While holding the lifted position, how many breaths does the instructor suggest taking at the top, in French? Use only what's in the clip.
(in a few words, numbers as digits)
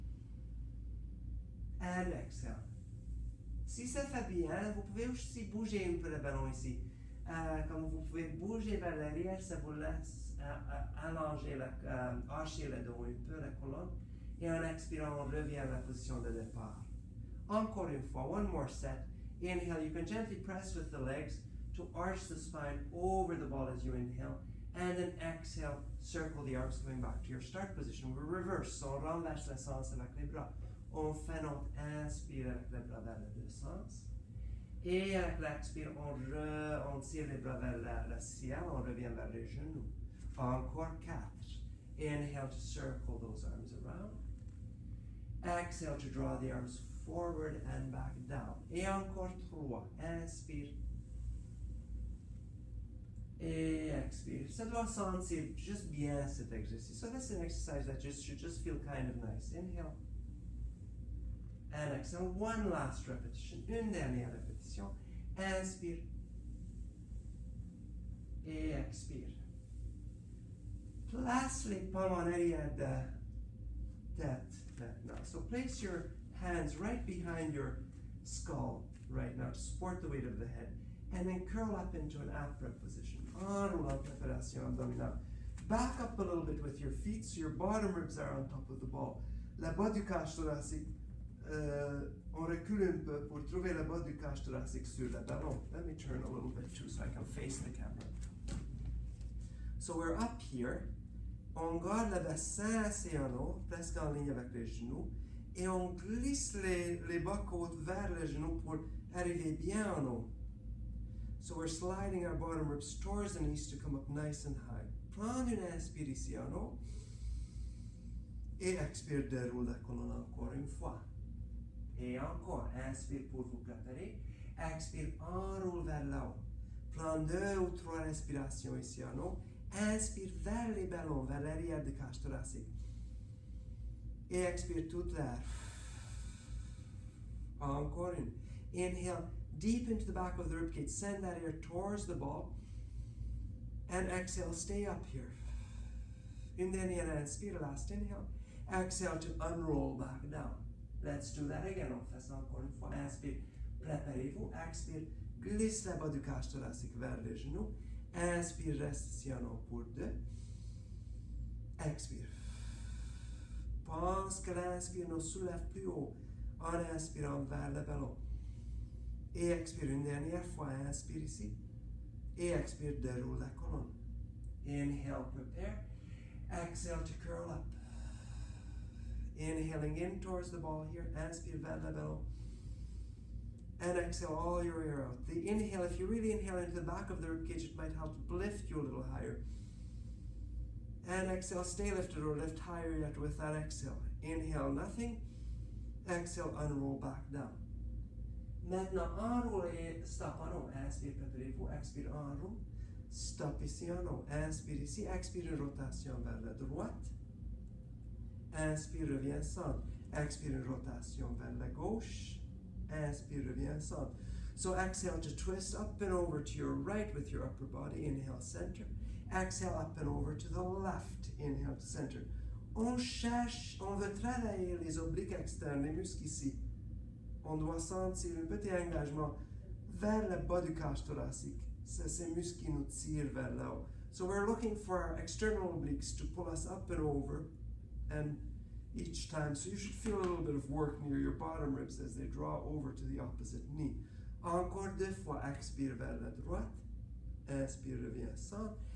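2 or 3.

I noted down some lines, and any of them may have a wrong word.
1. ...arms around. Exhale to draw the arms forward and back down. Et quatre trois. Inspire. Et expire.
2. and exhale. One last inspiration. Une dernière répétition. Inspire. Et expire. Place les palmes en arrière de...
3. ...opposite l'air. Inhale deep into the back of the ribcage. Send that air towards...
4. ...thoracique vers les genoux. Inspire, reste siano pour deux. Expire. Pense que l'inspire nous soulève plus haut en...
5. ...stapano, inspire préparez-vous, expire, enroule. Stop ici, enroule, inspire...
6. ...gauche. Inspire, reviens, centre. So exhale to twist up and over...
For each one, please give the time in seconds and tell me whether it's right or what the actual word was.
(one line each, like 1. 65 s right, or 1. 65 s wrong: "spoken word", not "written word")
1. 43 s wrong: "encore", not "quatre"
2. 61 s wrong: "repetition", not "inspiration"
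3. 134 s wrong: "toute", not "opposite"
4. 156 s right
5. 200 s right
6. 211 s right.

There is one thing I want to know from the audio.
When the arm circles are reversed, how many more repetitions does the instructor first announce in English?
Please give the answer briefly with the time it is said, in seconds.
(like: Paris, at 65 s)
4, at 40 s.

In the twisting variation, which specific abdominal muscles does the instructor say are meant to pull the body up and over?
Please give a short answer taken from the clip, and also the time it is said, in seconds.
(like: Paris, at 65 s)
external obliques, at 235 s.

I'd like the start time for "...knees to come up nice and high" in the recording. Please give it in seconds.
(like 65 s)
113 s.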